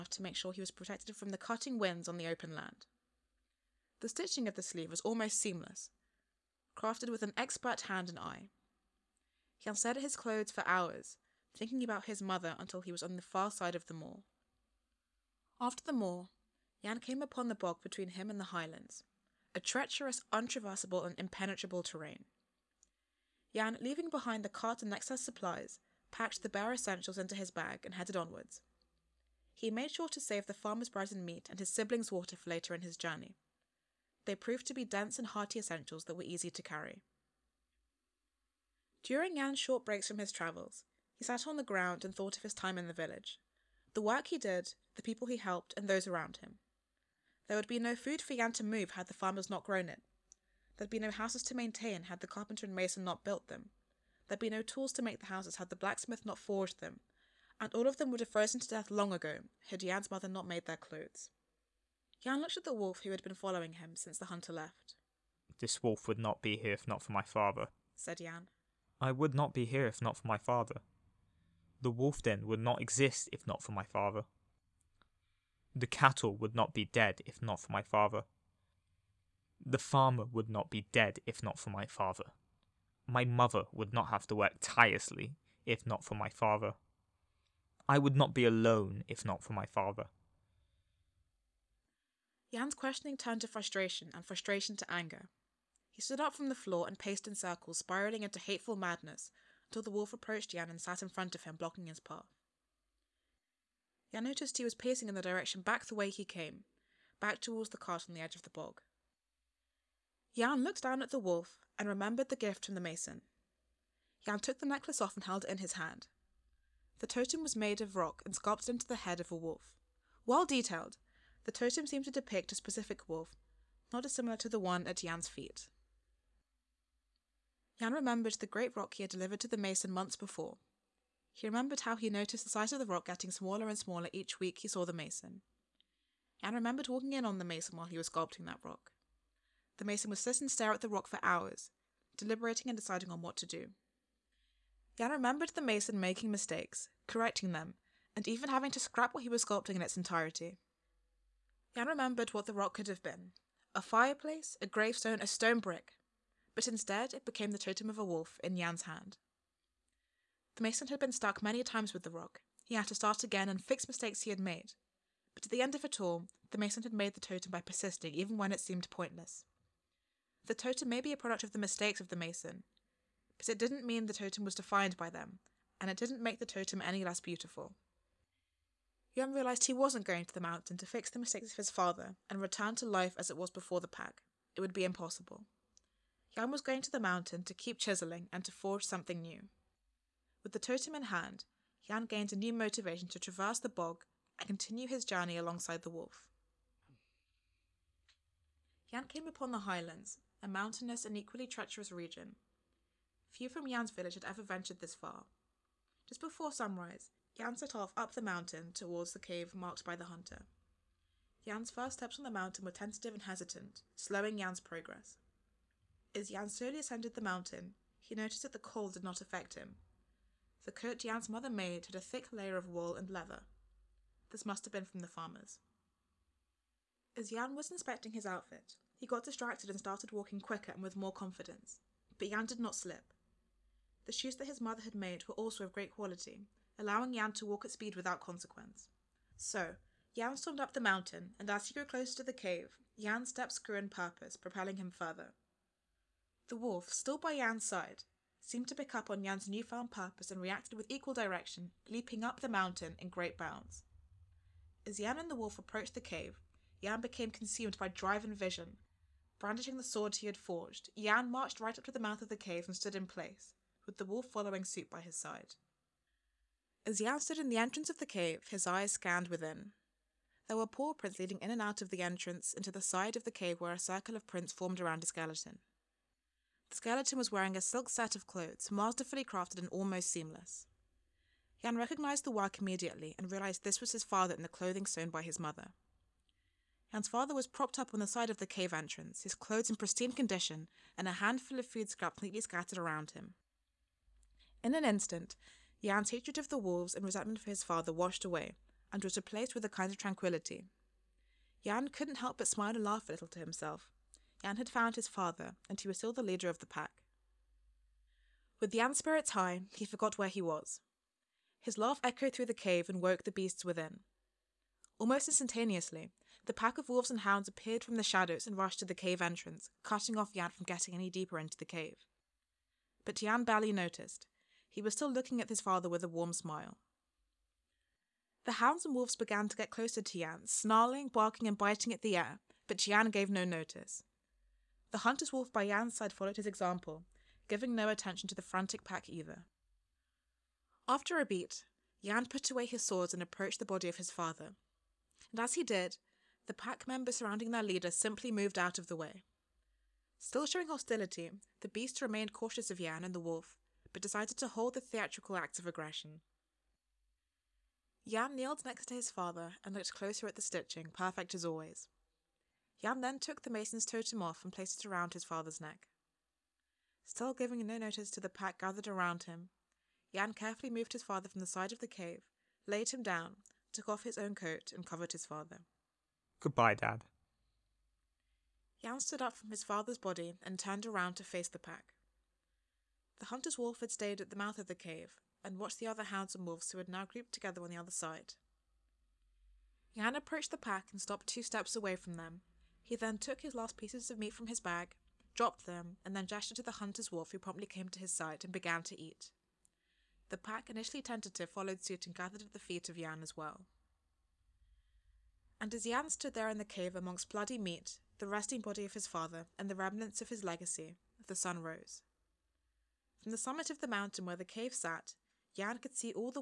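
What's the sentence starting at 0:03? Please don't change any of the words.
The stitching of the sleeve was almost seamless, crafted with an expert hand and eye.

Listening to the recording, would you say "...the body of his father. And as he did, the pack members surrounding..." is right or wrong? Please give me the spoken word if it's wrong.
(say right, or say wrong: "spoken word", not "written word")
right.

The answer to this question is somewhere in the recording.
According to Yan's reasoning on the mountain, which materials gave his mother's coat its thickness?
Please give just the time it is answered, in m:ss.
3:42.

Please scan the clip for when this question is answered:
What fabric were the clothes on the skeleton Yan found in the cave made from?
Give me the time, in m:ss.
4:37.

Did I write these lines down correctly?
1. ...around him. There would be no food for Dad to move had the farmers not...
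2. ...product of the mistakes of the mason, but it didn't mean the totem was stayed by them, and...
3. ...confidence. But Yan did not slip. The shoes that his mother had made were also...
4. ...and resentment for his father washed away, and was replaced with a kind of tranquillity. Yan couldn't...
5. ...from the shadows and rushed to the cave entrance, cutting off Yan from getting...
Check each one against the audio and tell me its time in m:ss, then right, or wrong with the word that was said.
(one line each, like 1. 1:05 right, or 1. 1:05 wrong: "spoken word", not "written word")
1. 0:46 wrong: "Yan", not "Dad"
2. 2:51 wrong: "defined", not "stayed"
3. 3:51 right
4. 4:56 right
5. 5:17 right.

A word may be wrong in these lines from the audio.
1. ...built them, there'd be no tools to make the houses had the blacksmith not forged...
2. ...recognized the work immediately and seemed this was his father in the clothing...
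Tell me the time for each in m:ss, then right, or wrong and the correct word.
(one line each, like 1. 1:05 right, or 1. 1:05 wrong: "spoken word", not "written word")
1. 0:53 right
2. 4:41 wrong: "realized", not "seemed".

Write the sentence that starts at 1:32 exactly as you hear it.
Yan's questioning turned to frustration and frustration to anger.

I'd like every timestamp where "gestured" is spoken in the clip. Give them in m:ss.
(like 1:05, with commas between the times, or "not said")
6:36.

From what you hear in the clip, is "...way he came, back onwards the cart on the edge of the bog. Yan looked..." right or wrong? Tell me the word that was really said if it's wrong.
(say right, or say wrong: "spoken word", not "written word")
wrong: "towards", not "onwards".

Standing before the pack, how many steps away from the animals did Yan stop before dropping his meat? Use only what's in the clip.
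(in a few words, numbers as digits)
2.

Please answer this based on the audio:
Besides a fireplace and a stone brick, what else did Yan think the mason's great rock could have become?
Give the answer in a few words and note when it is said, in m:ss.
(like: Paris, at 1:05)
A gravestone, at 2:34.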